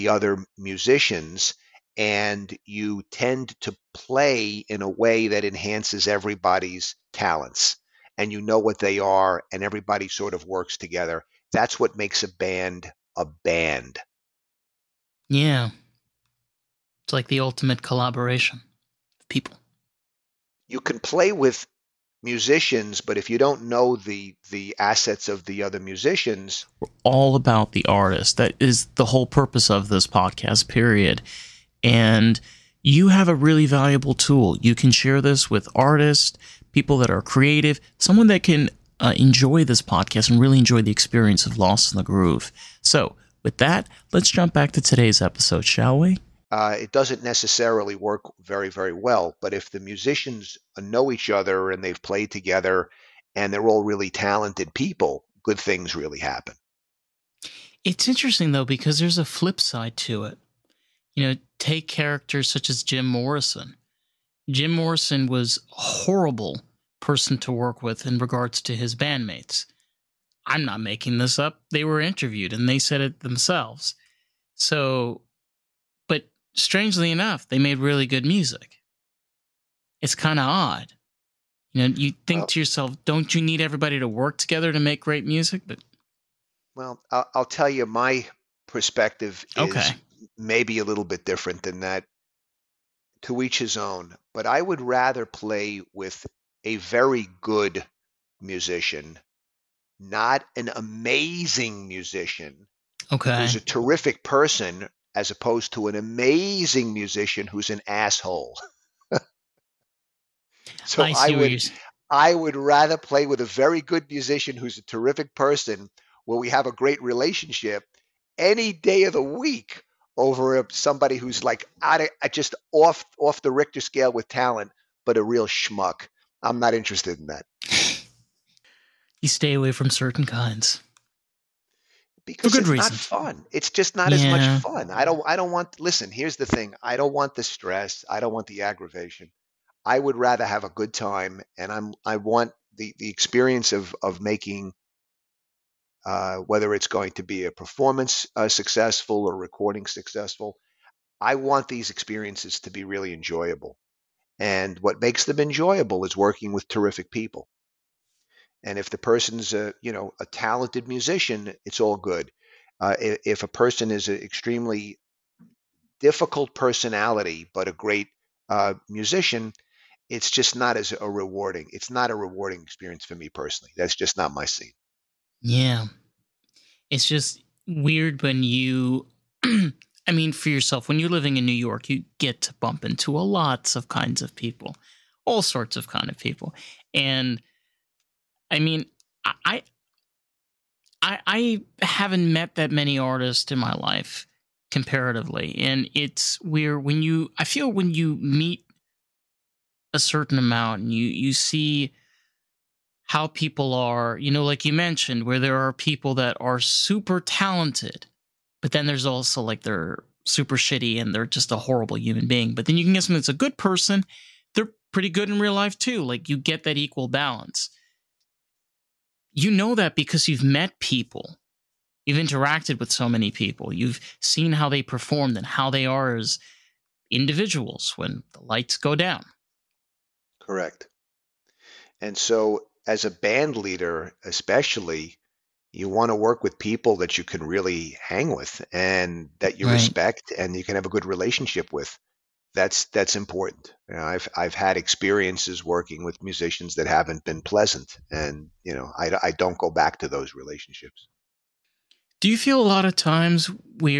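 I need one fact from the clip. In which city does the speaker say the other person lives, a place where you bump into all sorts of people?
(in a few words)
New York.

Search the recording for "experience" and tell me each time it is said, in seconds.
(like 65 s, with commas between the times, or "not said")
40 s, 143 s, 151 s, 172 s, 244 s.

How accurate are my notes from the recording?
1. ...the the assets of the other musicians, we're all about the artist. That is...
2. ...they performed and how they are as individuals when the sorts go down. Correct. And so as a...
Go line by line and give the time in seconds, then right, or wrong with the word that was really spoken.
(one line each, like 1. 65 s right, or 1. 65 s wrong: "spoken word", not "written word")
1. 23 s right
2. 224 s wrong: "lights", not "sorts".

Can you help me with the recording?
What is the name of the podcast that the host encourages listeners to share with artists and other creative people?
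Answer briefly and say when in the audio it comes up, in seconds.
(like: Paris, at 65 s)
Lost in the Groove, at 41 s.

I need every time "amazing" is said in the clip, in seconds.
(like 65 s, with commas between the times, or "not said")
100 s, 105 s.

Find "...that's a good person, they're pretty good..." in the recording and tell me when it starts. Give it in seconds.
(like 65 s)
213 s.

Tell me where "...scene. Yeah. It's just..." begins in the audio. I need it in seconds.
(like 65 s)
174 s.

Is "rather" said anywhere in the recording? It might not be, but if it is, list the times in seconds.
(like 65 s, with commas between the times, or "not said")
94 s, 112 s, 140 s.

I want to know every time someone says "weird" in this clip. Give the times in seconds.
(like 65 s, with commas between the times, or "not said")
177 s, 196 s.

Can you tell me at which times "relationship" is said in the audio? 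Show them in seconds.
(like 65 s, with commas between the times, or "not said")
117 s, 241 s, 250 s.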